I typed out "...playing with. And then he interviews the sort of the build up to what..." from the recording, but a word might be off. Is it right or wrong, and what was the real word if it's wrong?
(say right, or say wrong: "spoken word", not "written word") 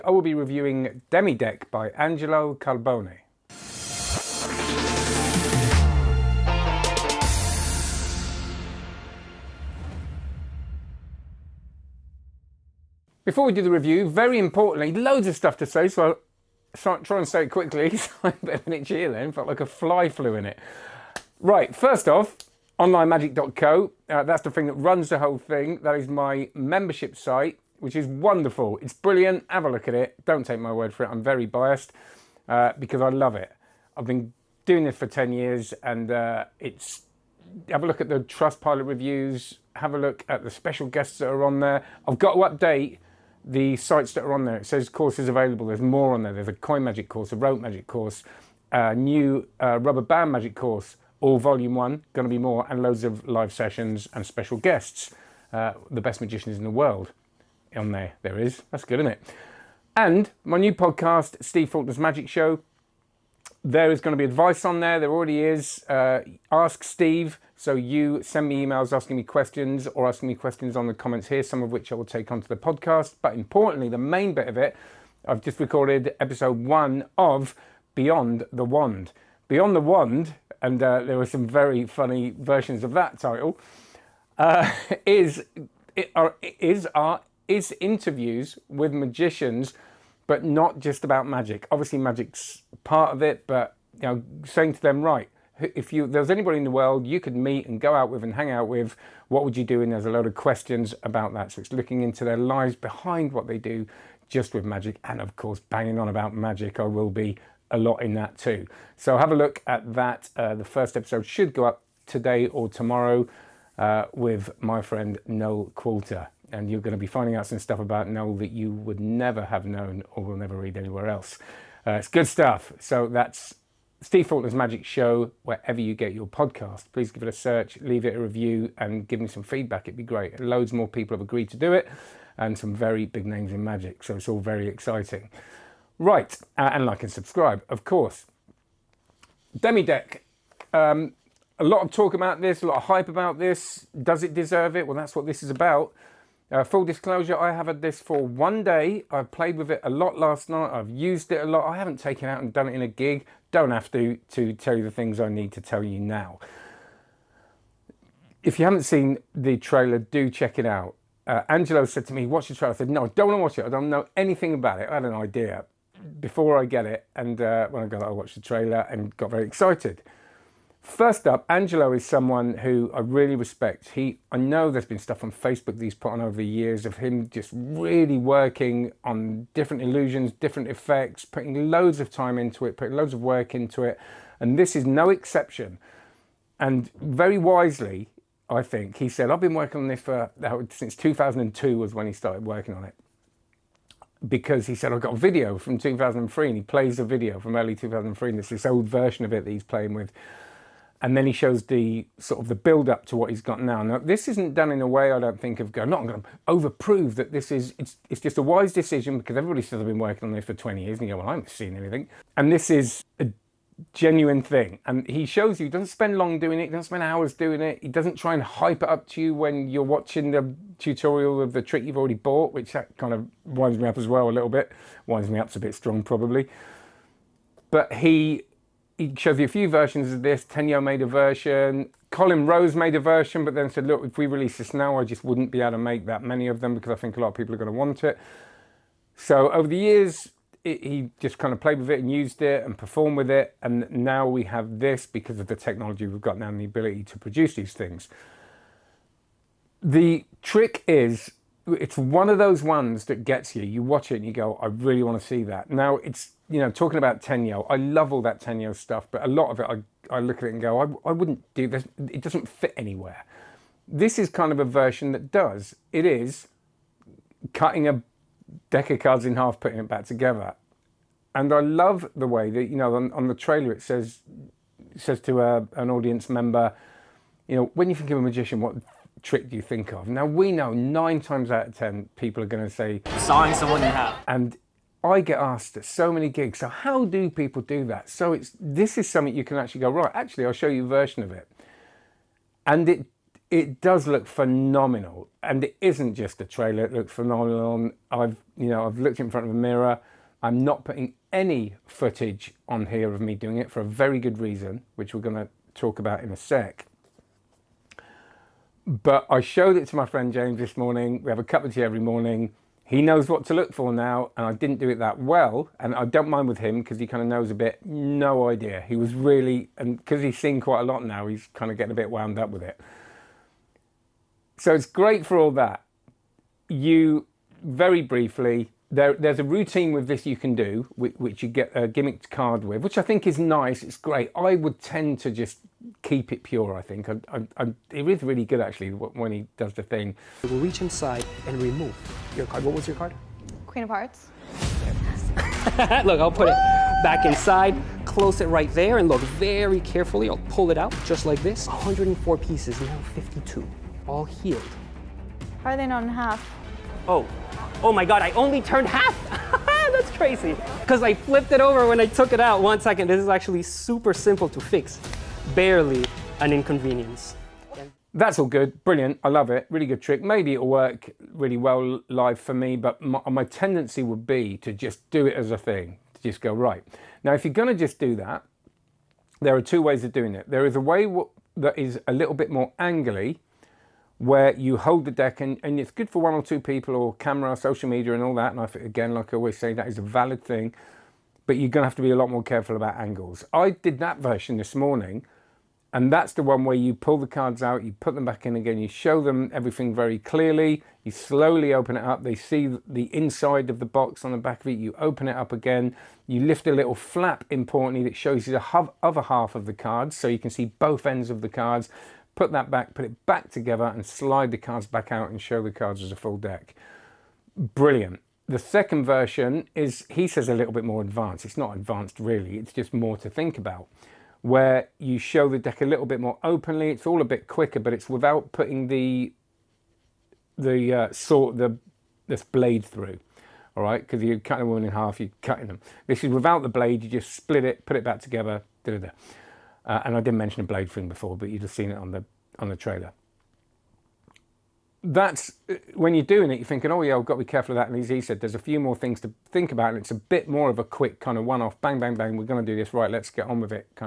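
wrong: "shows", not "interviews".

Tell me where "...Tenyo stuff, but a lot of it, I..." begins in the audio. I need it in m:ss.
4:18.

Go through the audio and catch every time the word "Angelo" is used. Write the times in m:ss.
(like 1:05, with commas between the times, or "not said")
0:01, 2:41, 2:51.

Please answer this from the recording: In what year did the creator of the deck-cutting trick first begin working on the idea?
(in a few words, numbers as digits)
2002.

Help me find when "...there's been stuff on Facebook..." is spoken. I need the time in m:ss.
2:54.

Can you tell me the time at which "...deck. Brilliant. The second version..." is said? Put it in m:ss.
6:56.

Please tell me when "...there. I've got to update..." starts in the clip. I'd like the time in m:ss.
0:41.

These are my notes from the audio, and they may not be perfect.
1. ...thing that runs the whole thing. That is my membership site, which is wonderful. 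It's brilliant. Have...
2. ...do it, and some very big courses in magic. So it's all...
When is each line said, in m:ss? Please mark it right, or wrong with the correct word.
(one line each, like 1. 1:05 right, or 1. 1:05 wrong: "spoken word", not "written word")
1. 0:24 right
2. 2:11 wrong: "names", not "courses".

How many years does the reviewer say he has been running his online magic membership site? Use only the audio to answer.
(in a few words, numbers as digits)
10 years.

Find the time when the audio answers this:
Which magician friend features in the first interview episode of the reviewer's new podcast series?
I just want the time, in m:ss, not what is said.
1:55.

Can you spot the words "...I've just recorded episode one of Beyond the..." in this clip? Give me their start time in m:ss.
1:15.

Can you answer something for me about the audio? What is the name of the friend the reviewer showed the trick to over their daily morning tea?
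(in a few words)
James.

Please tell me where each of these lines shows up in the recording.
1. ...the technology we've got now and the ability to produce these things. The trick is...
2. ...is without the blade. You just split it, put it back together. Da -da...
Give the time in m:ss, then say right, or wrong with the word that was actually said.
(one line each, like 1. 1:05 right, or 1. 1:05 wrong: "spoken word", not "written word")
1. 4:05 right
2. 7:16 right.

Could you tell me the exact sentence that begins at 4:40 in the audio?
Now, we know nine times out of 10, people are going to say, Sign someone you have.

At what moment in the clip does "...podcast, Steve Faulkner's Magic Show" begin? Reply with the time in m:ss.
1:00.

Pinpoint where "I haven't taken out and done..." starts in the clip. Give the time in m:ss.
2:31.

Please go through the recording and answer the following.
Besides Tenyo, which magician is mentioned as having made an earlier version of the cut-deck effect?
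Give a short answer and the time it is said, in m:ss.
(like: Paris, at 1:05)
Colin Rose, at 3:52.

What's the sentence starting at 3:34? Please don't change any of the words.
And he shows you, doesn't spend long doing it, doesn't spend hours doing it.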